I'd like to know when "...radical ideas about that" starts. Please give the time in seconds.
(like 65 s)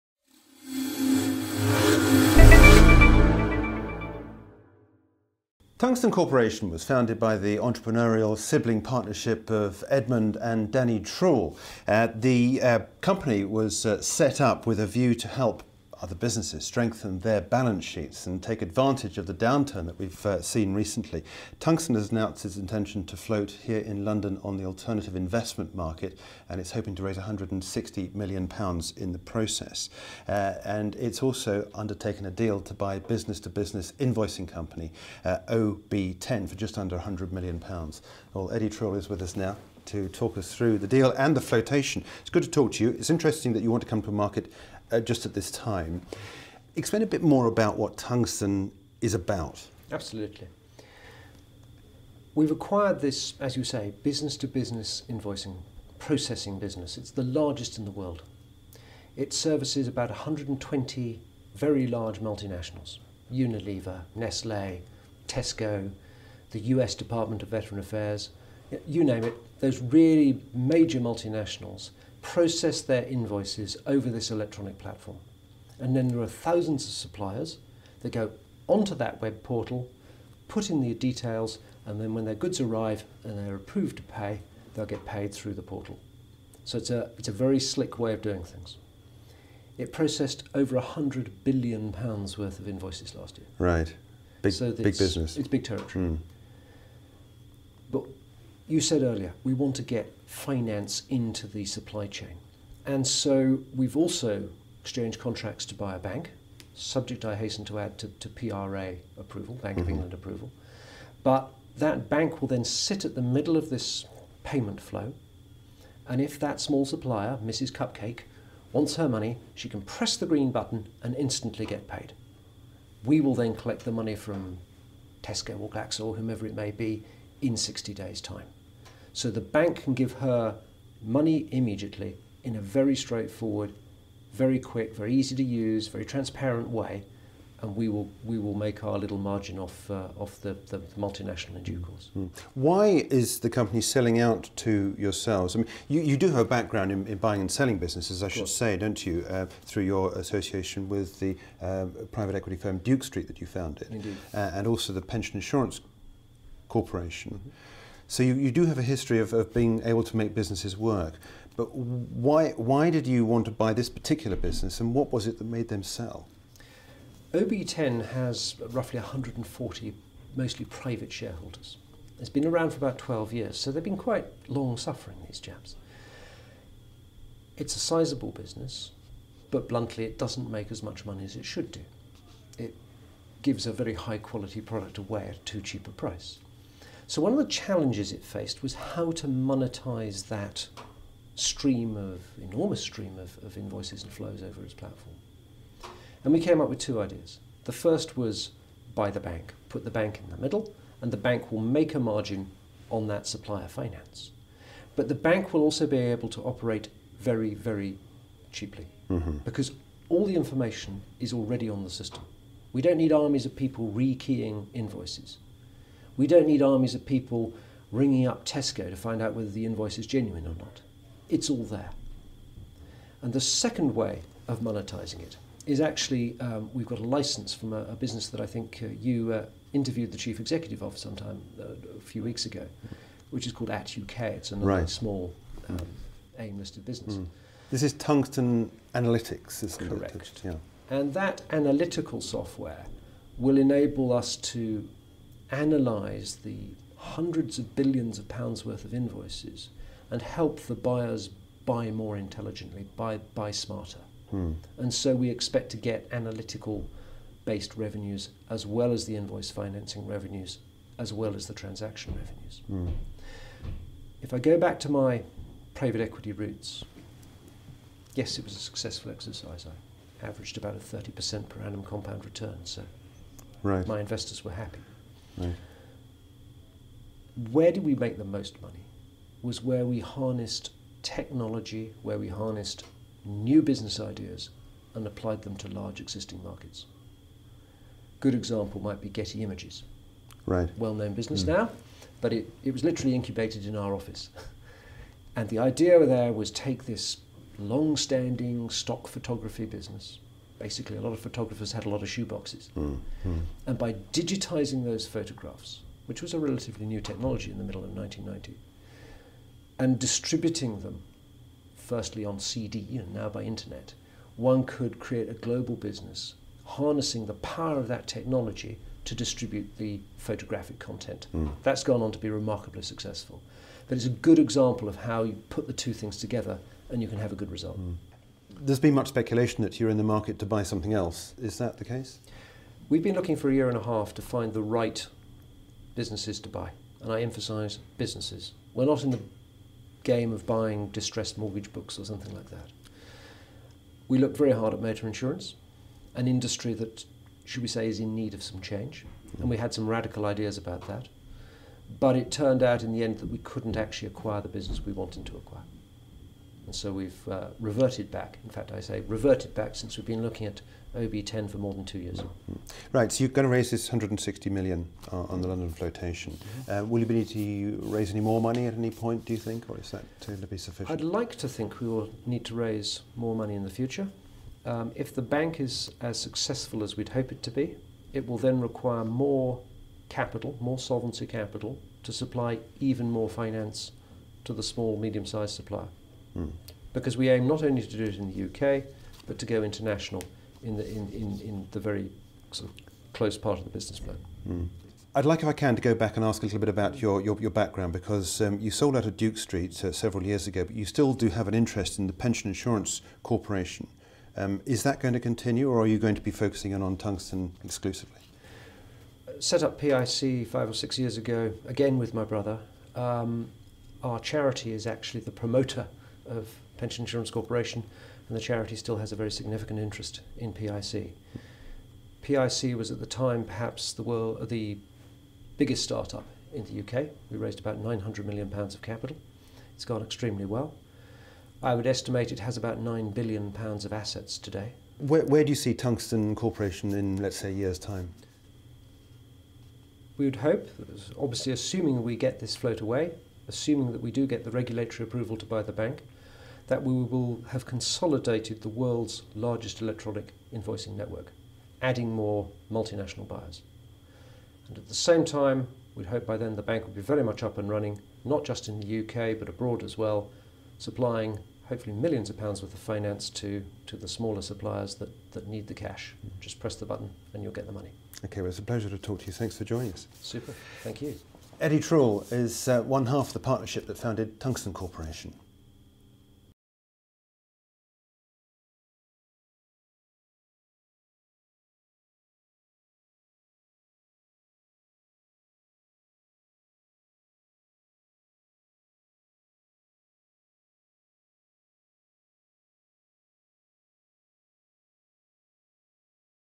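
349 s.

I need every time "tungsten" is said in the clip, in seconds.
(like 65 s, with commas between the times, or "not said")
5 s, 21 s, 47 s, 237 s, 406 s, 435 s, 474 s.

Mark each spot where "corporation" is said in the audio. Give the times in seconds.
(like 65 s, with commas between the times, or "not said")
6 s, 156 s, 403 s, 417 s, 436 s, 474 s.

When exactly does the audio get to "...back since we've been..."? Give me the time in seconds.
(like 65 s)
359 s.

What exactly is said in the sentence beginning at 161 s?
But why, why did you want to buy this particular business and what was it that made them sell?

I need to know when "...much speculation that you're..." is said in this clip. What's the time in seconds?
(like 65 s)
328 s.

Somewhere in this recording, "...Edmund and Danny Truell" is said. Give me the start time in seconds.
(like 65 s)
9 s.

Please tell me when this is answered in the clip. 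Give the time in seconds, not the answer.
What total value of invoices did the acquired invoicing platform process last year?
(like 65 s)
90 s.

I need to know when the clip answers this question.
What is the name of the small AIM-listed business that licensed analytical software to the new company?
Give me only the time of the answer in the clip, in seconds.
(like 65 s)
233 s.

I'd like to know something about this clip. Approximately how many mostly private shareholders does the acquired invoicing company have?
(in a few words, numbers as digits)
140.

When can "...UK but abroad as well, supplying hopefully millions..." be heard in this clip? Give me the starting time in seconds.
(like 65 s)
458 s.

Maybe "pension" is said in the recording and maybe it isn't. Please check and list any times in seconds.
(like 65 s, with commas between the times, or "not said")
155 s, 402 s, 416 s.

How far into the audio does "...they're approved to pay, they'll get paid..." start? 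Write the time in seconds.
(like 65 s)
83 s.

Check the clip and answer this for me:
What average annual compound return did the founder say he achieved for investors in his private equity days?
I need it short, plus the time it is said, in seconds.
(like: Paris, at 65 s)
30%, at 270 s.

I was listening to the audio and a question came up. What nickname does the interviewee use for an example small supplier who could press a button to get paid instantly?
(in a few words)
Mrs. Cupcake.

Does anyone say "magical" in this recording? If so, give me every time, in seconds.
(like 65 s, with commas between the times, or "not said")
not said.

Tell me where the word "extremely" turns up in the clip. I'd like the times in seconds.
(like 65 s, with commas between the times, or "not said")
430 s.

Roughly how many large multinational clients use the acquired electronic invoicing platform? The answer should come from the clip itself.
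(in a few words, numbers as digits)
120.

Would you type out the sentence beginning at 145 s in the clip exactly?
I mean, you, you do have a background in, in buying and selling businesses, I should say, don't you?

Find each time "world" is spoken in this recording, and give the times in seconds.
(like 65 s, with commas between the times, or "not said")
57 s, 424 s, 448 s.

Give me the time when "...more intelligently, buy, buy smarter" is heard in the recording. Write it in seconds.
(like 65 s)
251 s.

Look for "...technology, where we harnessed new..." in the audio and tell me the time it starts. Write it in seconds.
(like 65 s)
281 s.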